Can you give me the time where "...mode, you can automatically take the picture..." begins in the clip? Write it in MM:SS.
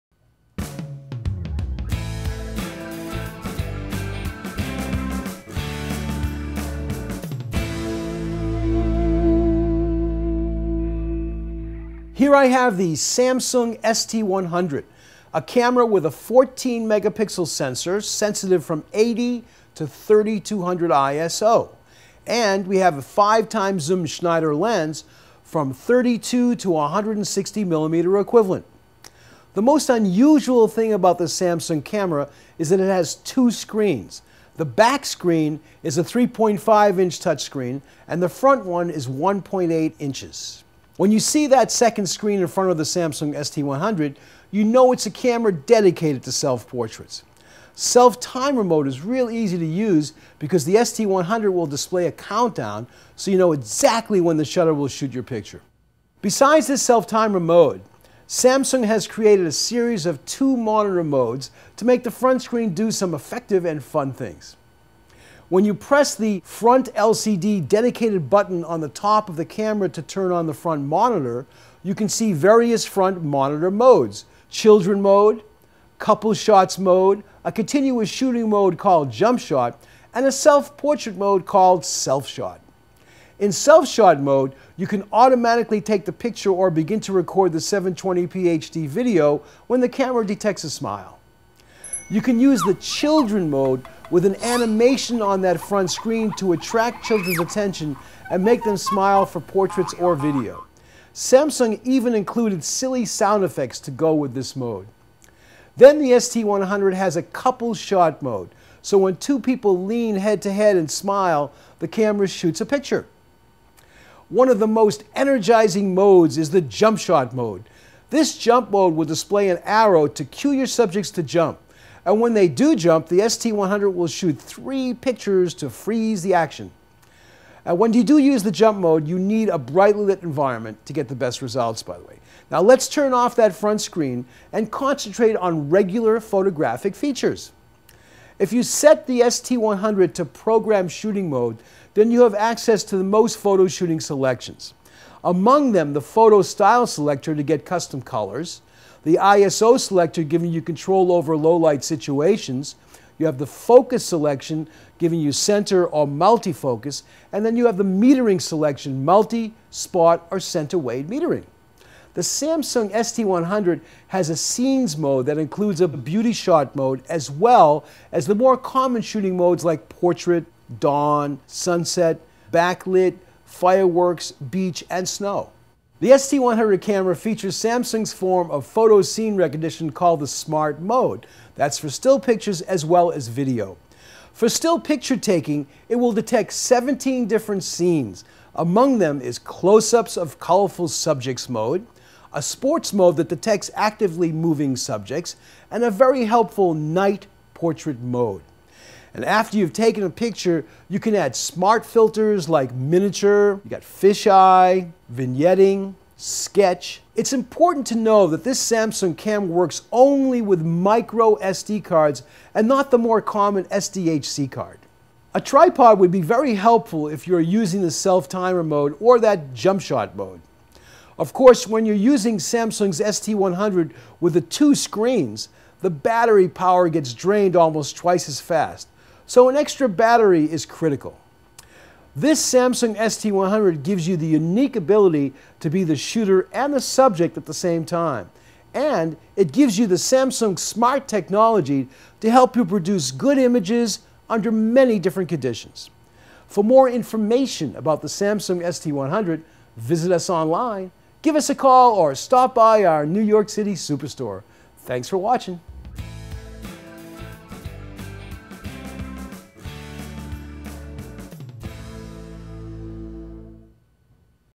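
01:24.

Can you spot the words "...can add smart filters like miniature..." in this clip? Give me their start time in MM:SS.
03:20.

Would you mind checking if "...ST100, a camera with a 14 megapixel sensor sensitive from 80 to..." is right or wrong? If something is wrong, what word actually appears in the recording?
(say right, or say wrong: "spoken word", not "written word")
right.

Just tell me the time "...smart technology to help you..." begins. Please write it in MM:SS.
04:00.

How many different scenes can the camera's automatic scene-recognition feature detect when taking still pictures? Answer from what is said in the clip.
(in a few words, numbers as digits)
17.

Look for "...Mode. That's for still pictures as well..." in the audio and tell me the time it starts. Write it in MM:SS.
03:00.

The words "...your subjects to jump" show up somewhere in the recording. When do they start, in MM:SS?
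02:00.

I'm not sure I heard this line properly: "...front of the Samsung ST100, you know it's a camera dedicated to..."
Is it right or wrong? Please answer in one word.
right.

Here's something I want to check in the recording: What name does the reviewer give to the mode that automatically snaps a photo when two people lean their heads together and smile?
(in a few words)
couple shot mode.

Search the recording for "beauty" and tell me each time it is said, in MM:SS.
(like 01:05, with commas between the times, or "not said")
02:45.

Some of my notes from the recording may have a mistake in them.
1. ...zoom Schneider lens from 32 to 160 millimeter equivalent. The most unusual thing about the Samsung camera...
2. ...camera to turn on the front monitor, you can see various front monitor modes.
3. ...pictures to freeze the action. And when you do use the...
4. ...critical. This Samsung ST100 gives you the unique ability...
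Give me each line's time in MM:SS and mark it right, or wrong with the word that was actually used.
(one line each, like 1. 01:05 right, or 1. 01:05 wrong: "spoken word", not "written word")
1. 00:23 right
2. 01:09 right
3. 02:04 right
4. 03:50 right.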